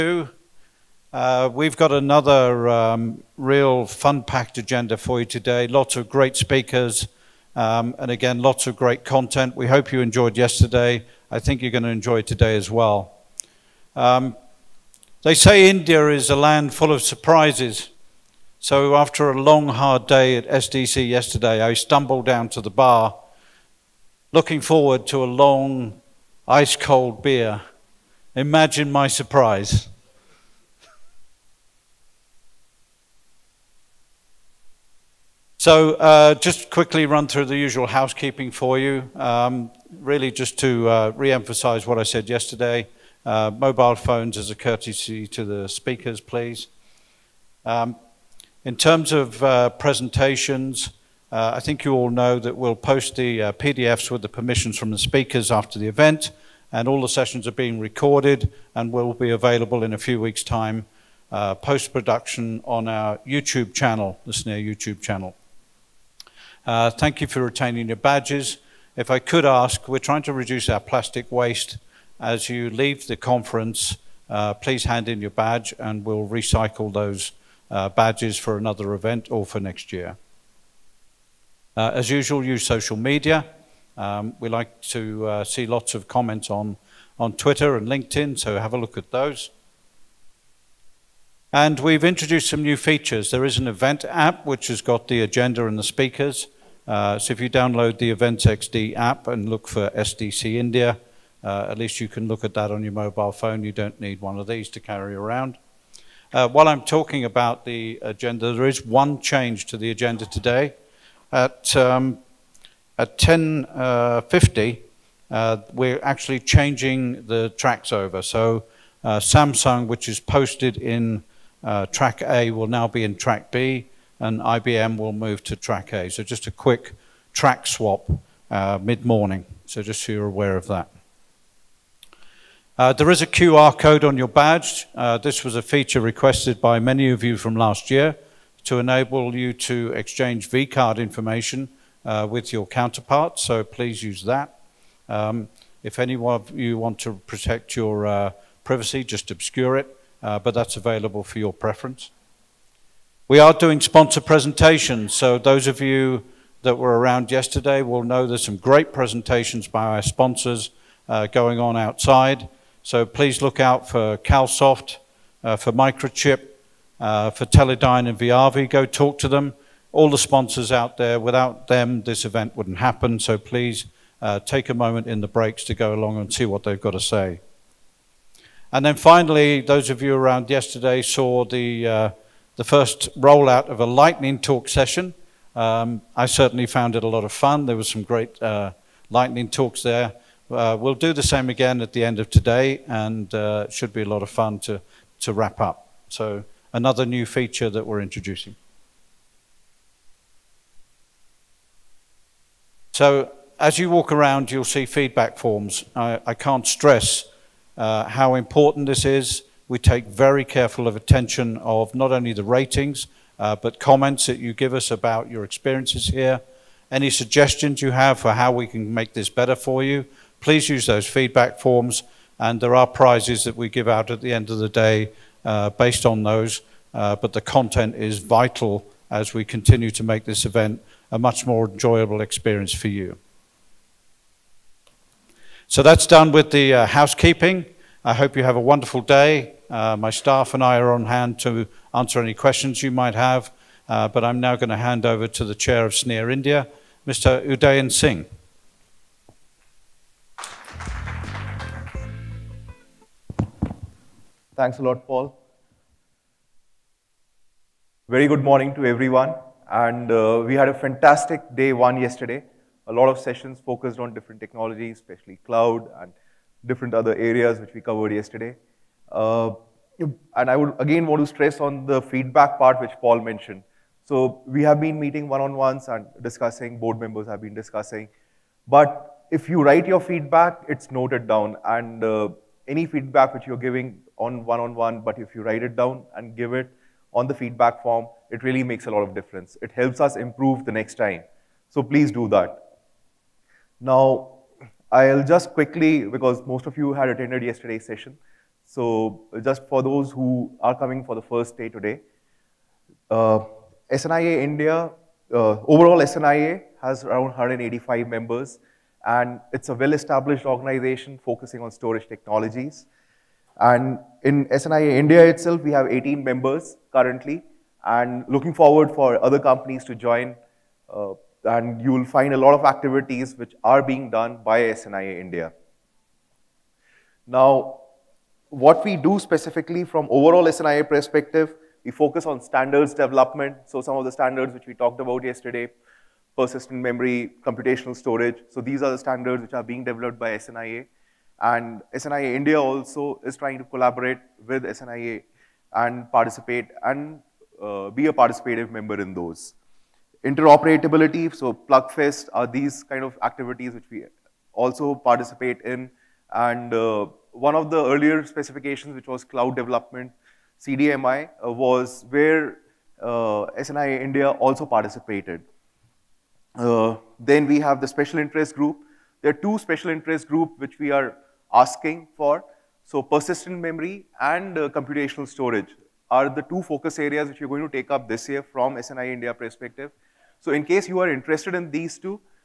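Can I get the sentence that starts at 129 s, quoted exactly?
So just so you're aware of that.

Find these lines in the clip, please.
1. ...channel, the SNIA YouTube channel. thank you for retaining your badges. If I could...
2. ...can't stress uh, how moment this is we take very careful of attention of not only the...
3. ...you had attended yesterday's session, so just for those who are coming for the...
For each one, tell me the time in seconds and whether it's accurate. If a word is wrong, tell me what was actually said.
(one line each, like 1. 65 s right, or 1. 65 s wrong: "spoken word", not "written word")
1. 63 s right
2. 206 s wrong: "important", not "moment"
3. 296 s right.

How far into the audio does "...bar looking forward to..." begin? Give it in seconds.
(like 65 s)
22 s.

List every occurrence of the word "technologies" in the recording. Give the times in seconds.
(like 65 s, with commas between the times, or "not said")
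264 s, 312 s.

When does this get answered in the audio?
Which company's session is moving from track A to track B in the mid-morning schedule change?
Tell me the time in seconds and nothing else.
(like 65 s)
119 s.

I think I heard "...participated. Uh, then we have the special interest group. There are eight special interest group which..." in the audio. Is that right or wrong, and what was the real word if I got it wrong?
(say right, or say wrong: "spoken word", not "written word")
wrong: "two", not "eight".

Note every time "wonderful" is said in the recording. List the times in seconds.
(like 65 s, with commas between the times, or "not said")
238 s.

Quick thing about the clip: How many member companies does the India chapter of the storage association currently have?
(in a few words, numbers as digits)
18.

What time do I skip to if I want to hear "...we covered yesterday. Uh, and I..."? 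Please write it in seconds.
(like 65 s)
267 s.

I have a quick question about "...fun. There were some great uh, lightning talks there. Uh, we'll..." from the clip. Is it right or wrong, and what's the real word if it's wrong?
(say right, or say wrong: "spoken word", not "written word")
right.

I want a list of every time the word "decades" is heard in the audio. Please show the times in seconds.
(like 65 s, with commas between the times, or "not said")
not said.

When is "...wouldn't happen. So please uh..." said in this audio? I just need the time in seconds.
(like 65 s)
172 s.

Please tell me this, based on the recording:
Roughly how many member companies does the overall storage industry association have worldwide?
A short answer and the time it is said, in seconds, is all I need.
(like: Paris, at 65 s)
185, at 307 s.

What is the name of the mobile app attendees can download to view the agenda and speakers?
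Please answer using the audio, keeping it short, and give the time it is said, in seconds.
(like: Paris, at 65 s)
Events XD, at 98 s.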